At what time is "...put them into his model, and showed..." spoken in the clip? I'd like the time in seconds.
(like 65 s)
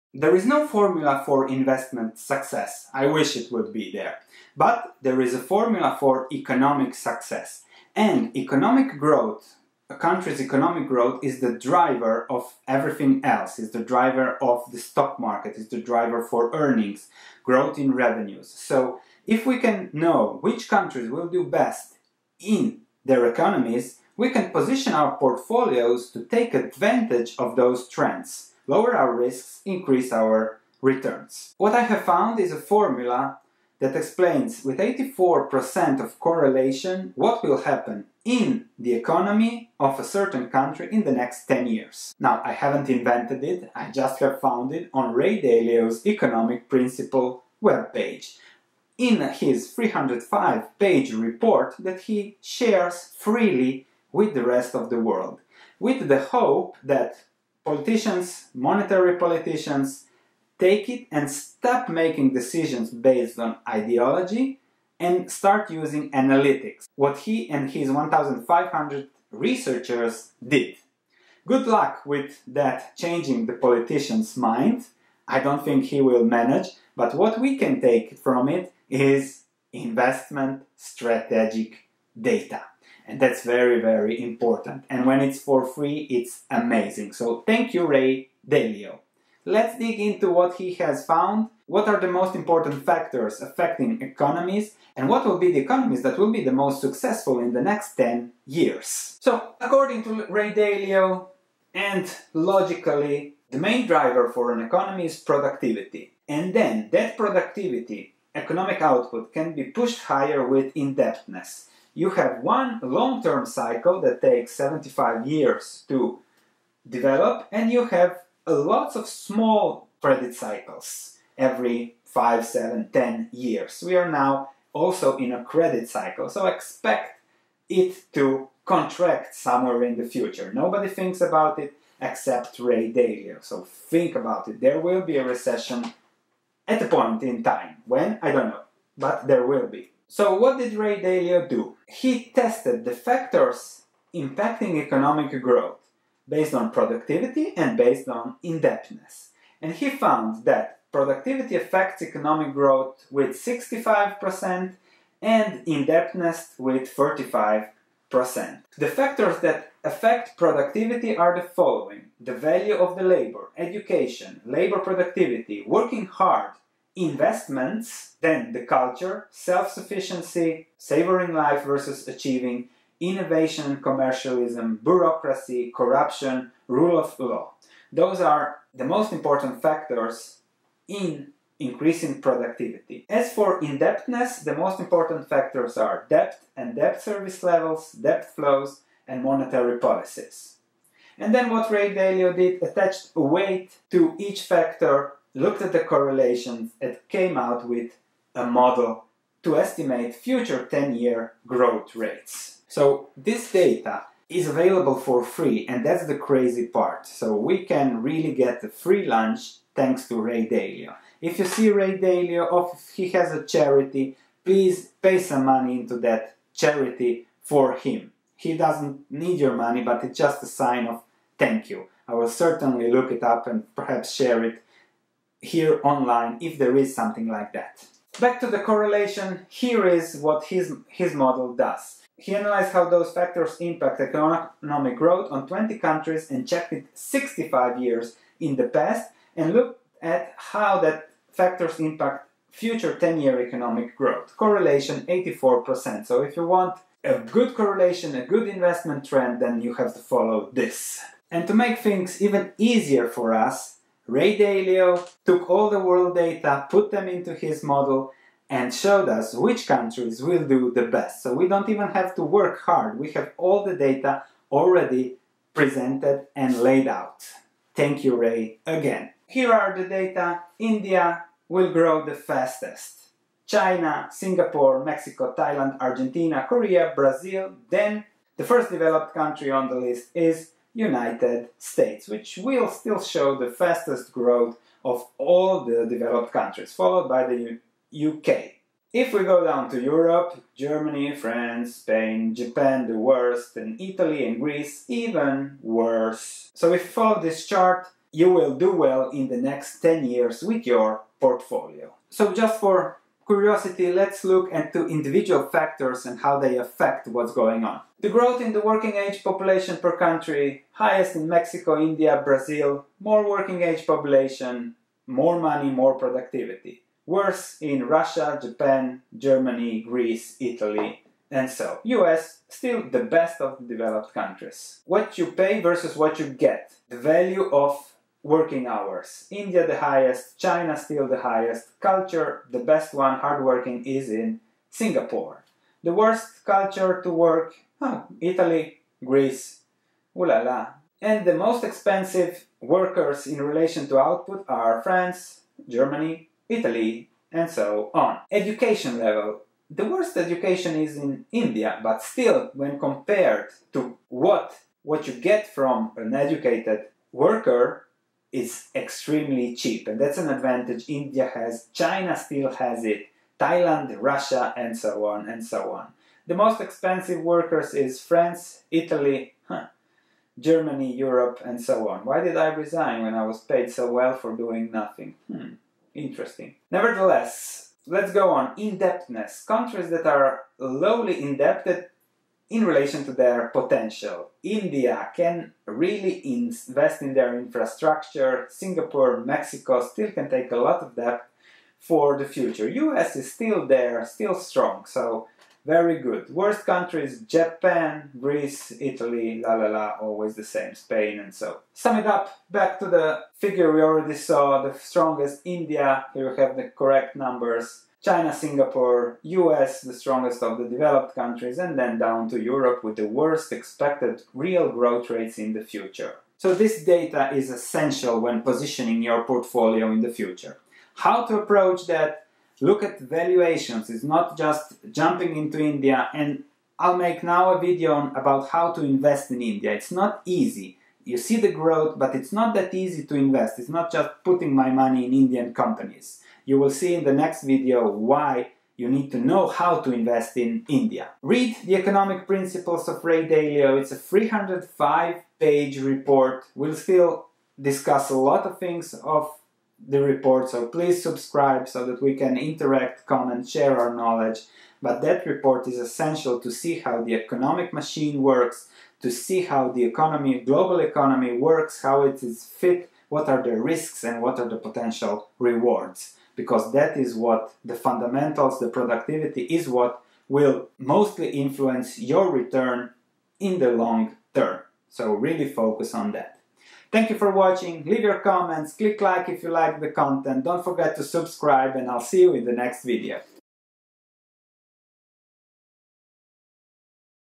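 256 s.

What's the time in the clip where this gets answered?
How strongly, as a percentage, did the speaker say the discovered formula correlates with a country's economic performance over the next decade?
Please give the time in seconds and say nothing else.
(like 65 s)
34 s.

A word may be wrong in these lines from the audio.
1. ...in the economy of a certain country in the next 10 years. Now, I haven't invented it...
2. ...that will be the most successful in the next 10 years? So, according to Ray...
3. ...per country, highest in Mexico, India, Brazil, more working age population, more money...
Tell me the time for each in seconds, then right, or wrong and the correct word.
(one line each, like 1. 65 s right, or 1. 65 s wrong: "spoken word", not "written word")
1. 38 s right
2. 96 s right
3. 309 s right.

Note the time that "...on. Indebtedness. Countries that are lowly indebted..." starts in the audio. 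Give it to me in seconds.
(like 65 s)
378 s.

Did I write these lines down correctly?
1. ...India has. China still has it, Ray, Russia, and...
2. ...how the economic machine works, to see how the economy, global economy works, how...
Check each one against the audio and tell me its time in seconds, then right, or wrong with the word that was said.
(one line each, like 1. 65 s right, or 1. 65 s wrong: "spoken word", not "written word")
1. 360 s wrong: "Thailand", not "Ray"
2. 456 s right.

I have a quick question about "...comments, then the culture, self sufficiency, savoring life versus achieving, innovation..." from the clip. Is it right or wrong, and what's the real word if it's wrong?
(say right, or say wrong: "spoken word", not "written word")
wrong: "investments", not "comments".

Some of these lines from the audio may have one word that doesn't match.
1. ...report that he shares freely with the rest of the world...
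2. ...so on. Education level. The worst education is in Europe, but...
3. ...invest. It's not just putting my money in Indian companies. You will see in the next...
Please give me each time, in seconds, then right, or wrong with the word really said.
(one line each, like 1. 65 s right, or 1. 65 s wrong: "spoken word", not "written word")
1. 51 s right
2. 347 s wrong: "India", not "Europe"
3. 433 s right.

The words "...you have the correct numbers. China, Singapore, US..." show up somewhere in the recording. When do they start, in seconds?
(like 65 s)
406 s.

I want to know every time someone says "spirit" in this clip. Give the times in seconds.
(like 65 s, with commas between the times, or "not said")
not said.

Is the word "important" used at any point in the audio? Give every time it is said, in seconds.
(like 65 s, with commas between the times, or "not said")
84 s, 92 s, 179 s, 184 s.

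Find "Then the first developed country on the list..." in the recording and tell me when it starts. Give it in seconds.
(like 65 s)
277 s.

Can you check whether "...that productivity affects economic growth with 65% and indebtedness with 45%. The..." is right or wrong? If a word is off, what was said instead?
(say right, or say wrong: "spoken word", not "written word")
right.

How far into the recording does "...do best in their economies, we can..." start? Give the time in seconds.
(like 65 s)
21 s.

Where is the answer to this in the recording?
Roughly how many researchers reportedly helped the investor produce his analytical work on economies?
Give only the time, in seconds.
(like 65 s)
67 s.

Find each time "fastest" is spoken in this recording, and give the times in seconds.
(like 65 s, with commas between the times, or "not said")
272 s, 283 s.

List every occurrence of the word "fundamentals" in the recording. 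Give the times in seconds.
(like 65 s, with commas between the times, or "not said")
467 s.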